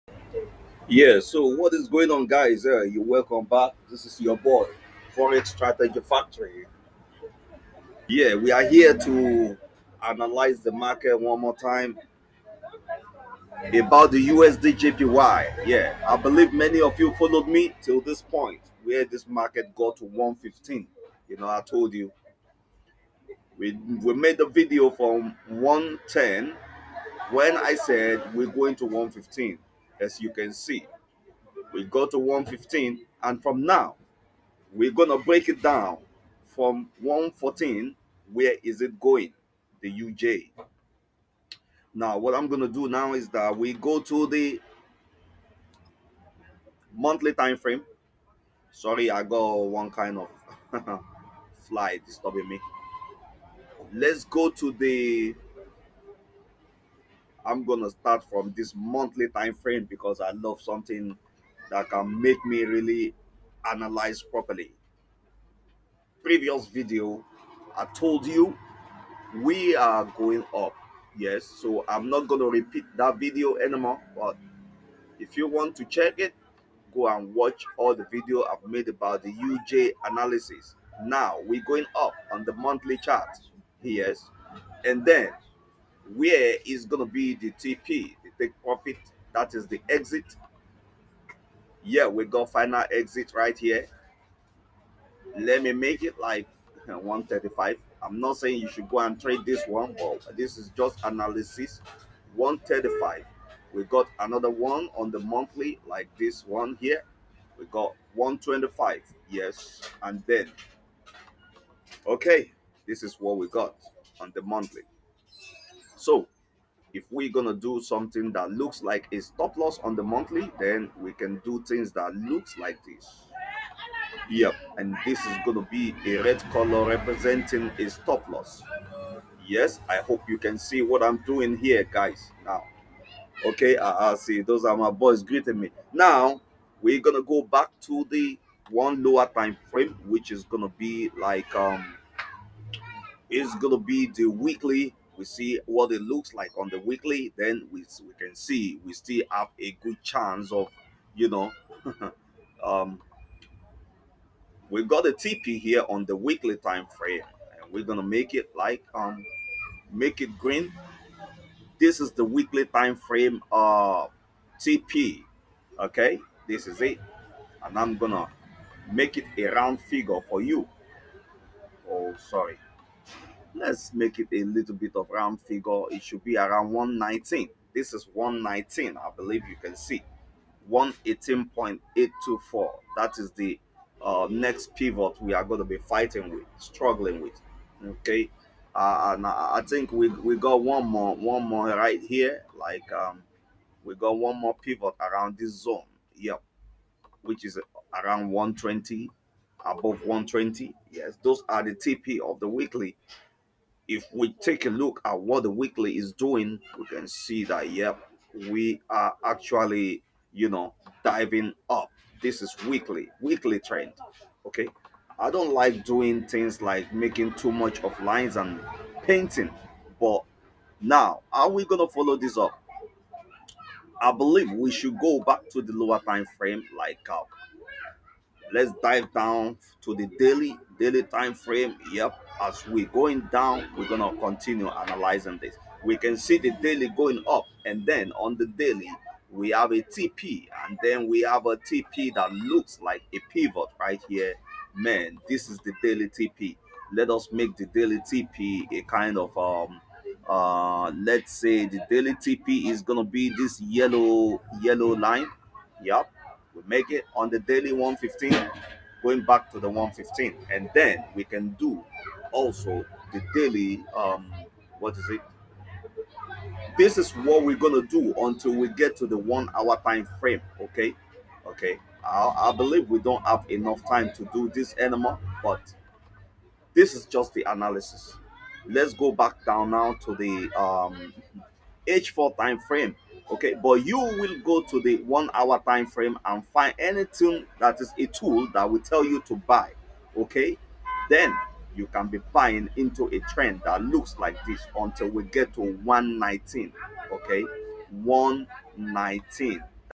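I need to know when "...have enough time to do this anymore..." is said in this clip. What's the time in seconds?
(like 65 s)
273 s.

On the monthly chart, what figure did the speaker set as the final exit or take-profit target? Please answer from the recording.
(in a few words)
135.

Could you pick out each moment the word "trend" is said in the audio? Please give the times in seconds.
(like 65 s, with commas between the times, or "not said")
213 s, 293 s.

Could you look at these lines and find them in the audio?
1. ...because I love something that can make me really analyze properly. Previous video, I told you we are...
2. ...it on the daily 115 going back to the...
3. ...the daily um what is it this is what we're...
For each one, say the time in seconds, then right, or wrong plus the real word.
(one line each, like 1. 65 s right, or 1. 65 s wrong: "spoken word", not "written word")
1. 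59 s right
2. 256 s right
3. 263 s right.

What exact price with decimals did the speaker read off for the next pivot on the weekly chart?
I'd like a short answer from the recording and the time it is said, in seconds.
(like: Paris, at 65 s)
118.824, at 180 s.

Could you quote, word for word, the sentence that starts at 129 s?
Yes, I hope you can see what I'm doing here, guys.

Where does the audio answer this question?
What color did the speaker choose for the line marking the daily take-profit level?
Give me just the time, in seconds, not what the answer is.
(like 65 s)
253 s.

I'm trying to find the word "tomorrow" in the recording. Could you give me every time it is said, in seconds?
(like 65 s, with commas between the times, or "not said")
not said.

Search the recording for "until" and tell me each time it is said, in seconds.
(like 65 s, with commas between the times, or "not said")
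268 s, 294 s.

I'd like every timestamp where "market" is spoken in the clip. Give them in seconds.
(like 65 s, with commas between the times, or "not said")
10 s, 19 s.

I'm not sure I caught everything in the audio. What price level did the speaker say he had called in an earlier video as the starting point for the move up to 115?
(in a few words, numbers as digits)
110.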